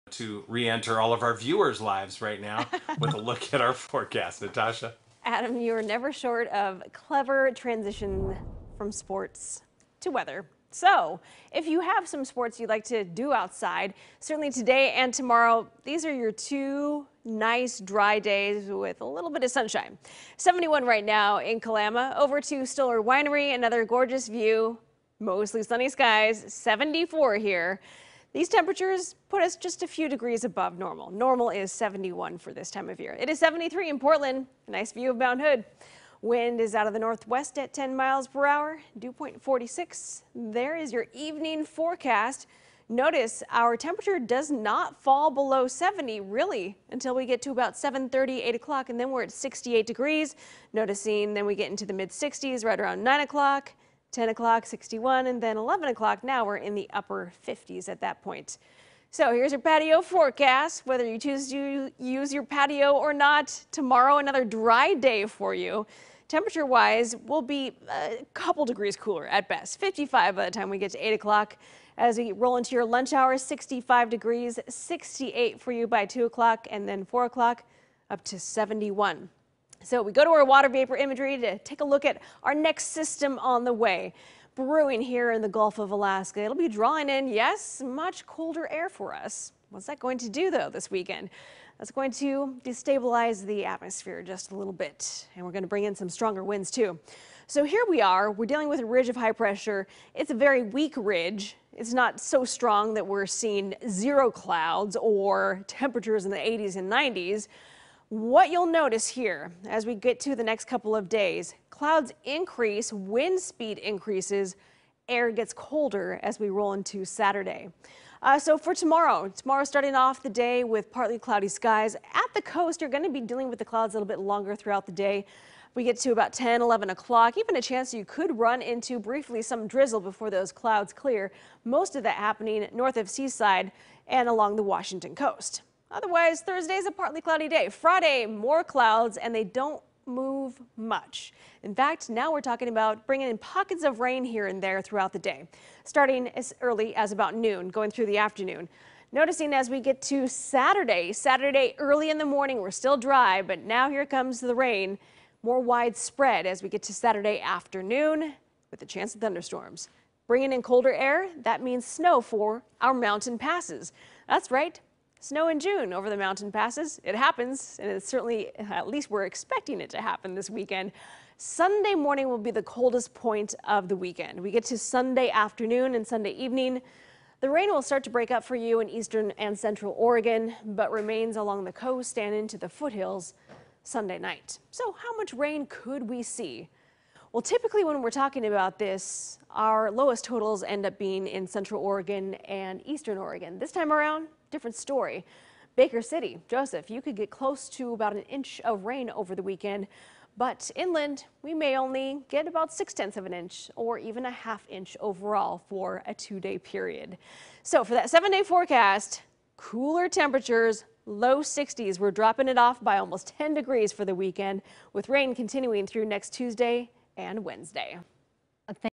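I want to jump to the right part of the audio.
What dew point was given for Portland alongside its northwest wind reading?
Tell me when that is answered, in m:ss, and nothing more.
0:38.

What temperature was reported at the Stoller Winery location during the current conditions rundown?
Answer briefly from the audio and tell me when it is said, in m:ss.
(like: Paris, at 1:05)
74, at 0:26.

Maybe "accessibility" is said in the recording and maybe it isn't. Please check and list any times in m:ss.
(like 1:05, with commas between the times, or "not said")
not said.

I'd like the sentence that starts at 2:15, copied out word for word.
Otherwise, Thursday's a partly cloudy day.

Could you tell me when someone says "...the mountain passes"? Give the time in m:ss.
2:46.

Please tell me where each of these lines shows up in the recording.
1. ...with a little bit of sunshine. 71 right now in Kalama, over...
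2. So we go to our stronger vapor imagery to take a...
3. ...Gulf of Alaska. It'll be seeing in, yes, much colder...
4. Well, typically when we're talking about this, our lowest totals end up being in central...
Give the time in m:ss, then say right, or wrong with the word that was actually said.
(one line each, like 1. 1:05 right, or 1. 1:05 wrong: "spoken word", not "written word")
1. 0:18 right
2. 1:19 wrong: "water", not "stronger"
3. 1:25 wrong: "drawing", not "seeing"
4. 3:07 right.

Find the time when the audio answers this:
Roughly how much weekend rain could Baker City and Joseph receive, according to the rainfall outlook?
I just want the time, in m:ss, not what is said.
3:17.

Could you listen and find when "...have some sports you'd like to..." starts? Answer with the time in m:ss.
0:11.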